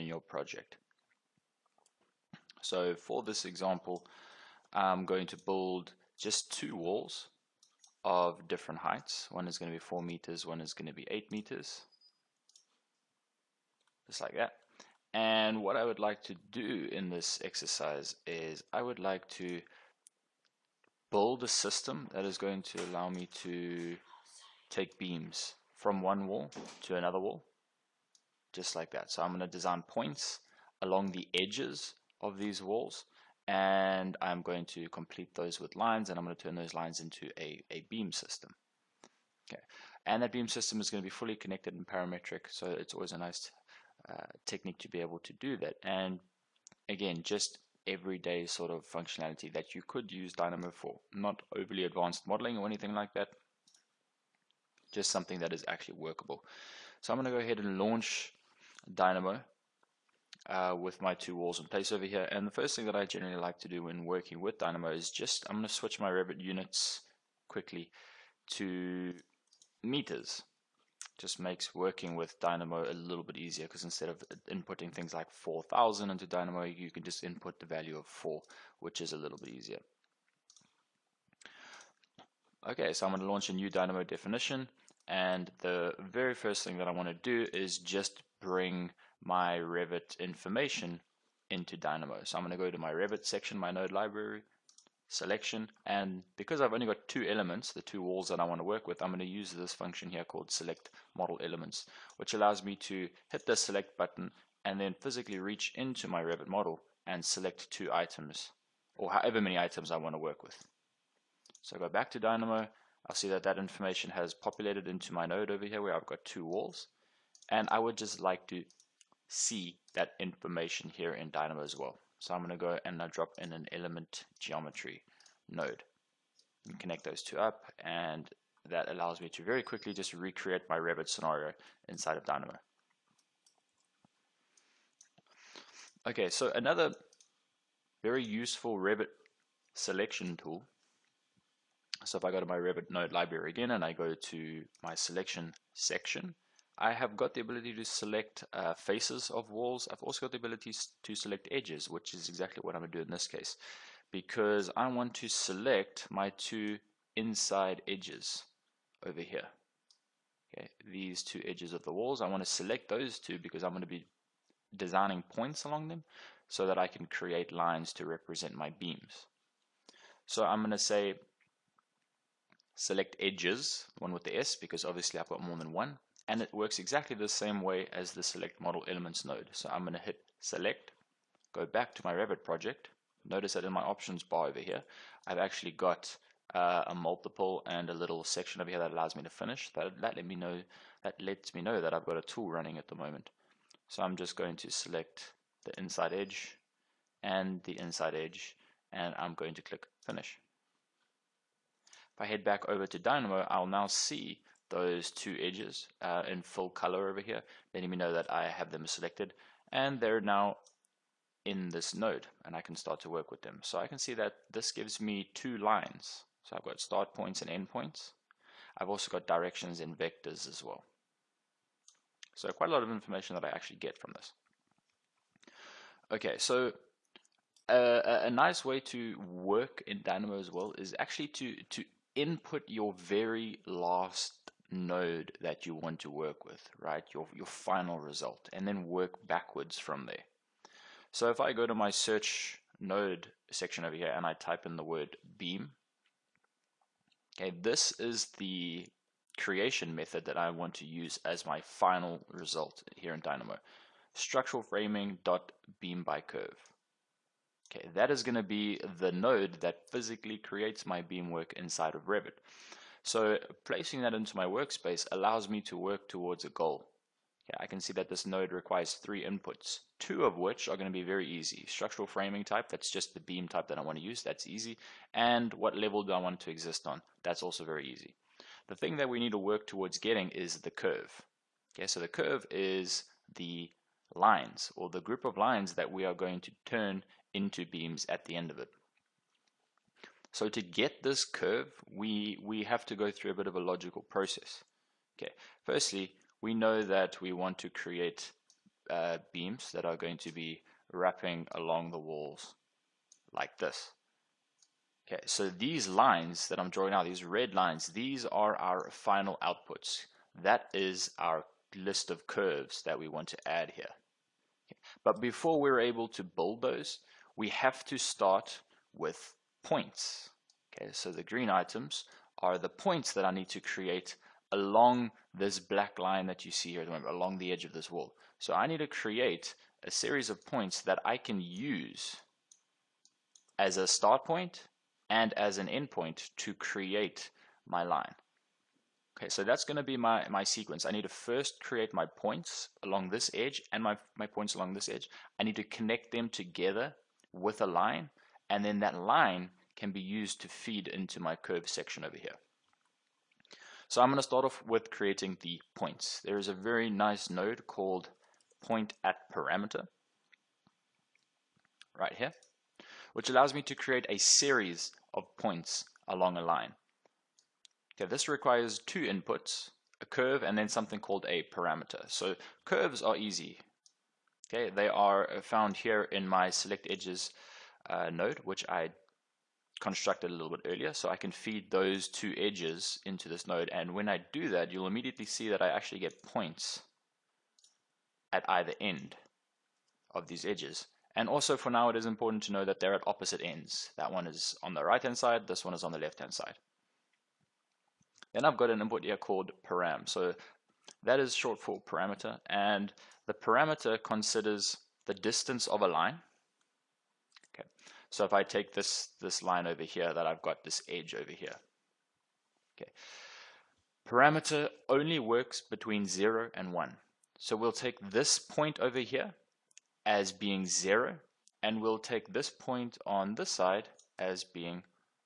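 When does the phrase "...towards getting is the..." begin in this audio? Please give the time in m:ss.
4:39.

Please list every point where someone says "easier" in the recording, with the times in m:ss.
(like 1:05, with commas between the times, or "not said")
1:13, 1:19.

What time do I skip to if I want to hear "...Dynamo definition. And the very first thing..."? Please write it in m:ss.
1:23.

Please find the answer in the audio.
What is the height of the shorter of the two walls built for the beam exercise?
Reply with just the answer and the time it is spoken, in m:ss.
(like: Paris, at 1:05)
4 meters, at 0:09.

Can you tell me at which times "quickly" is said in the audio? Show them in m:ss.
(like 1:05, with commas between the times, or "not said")
1:07, 2:09.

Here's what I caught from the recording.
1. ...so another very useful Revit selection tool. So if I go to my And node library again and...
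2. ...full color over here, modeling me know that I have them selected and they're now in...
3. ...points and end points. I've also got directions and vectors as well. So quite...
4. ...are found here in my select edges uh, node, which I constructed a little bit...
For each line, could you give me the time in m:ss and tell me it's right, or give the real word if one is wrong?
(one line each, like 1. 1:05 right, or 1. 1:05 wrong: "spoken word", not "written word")
1. 2:16 wrong: "Revit", not "And"
2. 3:26 wrong: "letting", not "modeling"
3. 3:37 right
4. 6:14 right.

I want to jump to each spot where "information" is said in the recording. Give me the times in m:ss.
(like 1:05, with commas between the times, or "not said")
1:30, 1:53, 2:00, 3:42.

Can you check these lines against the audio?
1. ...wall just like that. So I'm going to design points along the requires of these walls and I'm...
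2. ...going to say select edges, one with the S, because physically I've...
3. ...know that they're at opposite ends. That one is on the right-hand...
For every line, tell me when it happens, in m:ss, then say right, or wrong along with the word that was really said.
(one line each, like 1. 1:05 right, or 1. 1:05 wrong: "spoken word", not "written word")
1. 0:27 wrong: "edges", not "requires"
2. 2:50 wrong: "obviously", not "physically"
3. 6:32 right.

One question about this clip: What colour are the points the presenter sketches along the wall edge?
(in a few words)
green.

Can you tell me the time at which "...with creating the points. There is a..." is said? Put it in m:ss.
5:54.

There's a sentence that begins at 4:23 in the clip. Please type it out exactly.
So placing that into my workspace allows me to work towards a goal.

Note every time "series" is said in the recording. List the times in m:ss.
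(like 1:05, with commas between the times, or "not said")
5:29, 6:04.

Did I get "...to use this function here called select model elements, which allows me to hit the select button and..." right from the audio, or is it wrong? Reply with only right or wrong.
right.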